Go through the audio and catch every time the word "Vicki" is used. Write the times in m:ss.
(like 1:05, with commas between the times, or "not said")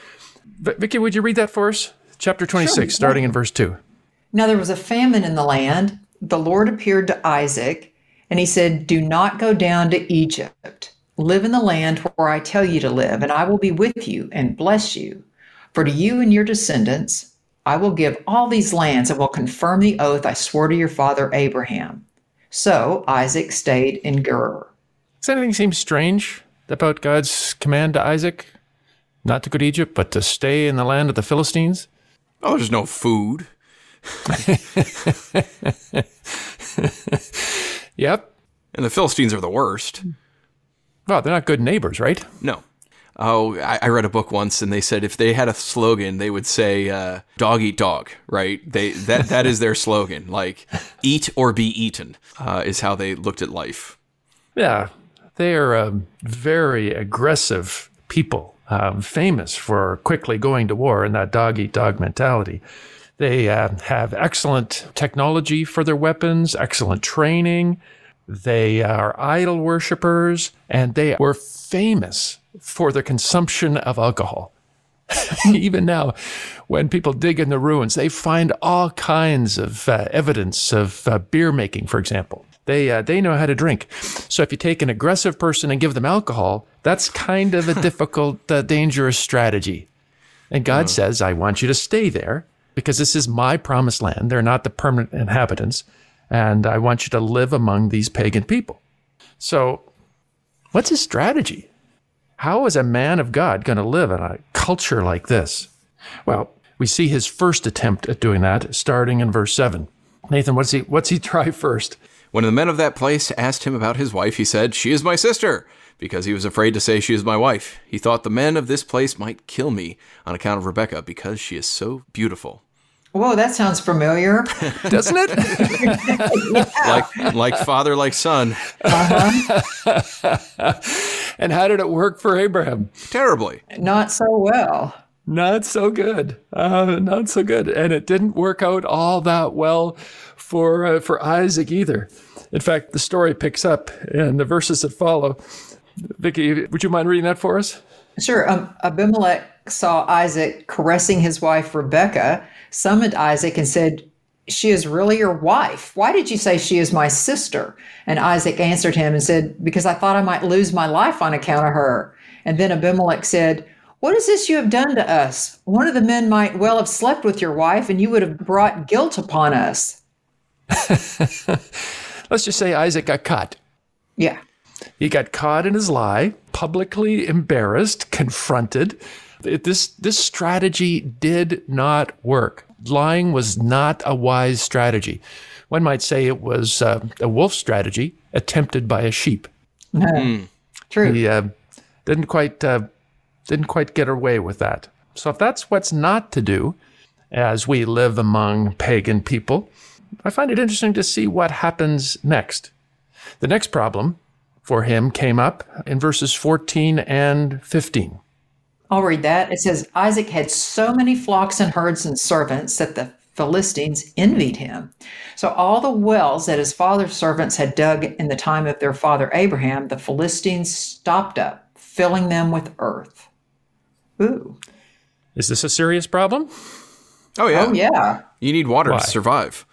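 2:26.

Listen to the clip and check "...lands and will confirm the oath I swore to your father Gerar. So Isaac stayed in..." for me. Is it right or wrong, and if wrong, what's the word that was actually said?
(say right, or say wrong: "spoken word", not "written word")
wrong: "Abraham", not "Gerar".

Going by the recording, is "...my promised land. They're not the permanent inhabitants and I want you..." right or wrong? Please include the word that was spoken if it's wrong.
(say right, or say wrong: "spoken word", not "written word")
right.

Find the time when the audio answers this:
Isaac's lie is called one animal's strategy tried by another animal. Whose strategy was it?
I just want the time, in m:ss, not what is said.
3:07.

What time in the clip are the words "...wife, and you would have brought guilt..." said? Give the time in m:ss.
2:47.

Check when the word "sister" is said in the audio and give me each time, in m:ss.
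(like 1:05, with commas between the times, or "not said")
1:55, 2:37.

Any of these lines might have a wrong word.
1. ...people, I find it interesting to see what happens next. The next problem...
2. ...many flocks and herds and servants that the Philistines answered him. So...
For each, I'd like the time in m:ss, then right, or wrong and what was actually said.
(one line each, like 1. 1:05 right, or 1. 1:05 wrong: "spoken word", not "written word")
1. 3:19 right
2. 3:30 wrong: "envied", not "answered".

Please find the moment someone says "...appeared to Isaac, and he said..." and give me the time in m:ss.
0:06.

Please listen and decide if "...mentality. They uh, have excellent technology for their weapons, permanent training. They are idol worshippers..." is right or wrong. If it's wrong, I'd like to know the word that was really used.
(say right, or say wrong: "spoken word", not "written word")
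wrong: "excellent", not "permanent".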